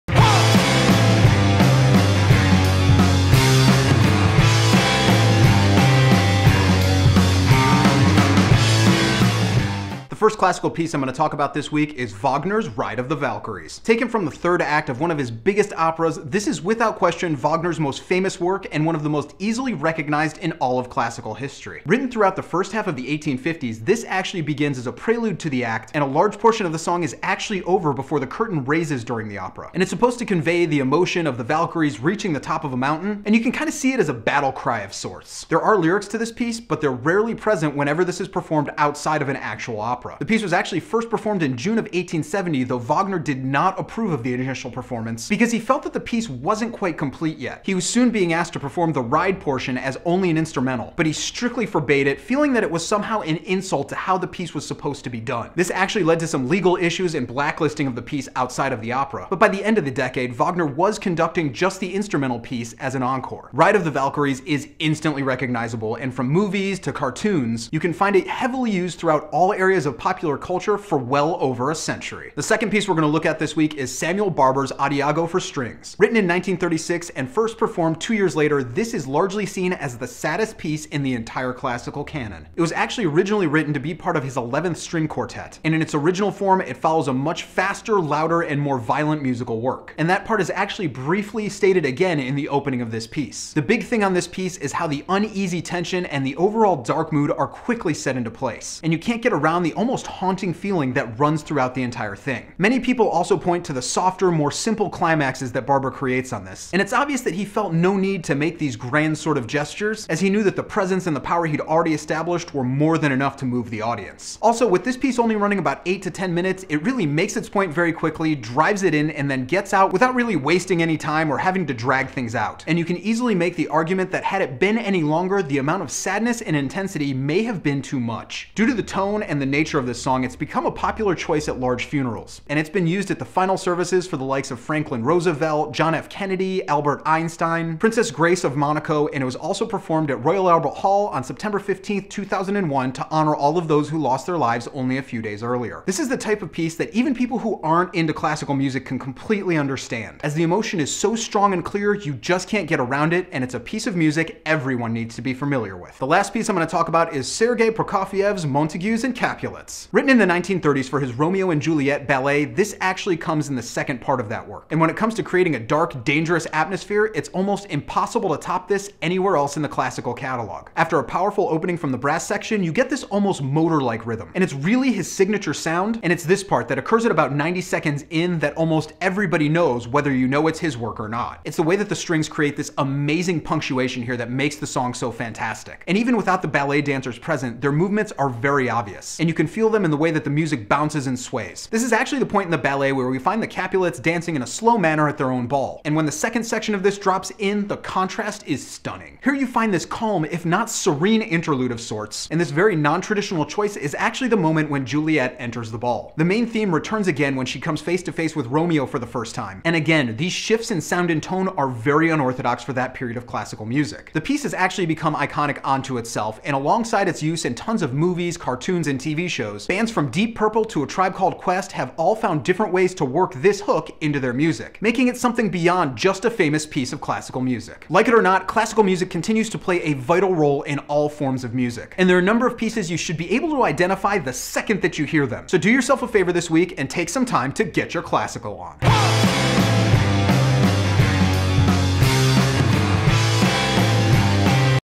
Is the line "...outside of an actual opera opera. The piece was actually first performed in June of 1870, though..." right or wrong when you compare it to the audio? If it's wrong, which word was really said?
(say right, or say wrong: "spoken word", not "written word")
right.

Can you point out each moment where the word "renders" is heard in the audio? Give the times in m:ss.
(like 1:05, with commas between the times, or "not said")
not said.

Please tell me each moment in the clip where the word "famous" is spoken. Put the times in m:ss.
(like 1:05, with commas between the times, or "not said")
0:18, 3:46.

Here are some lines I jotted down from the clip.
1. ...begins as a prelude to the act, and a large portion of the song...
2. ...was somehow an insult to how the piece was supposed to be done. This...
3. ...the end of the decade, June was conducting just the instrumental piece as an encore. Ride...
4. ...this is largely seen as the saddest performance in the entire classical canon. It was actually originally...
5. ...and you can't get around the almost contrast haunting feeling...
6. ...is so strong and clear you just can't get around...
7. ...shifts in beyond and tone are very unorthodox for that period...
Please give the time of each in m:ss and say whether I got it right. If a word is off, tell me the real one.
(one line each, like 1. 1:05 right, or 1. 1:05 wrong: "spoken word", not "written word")
1. 0:24 right
2. 0:52 right
3. 0:59 wrong: "Wagner", not "June"
4. 1:18 wrong: "piece", not "performance"
5. 1:38 wrong: "almost", not "contrast"
6. 2:30 right
7. 3:30 wrong: "sound", not "beyond".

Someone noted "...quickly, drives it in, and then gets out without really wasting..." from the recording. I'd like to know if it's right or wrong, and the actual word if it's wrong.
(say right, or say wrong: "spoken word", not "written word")
right.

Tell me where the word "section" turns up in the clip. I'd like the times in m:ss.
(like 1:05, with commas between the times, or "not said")
2:52, 3:16.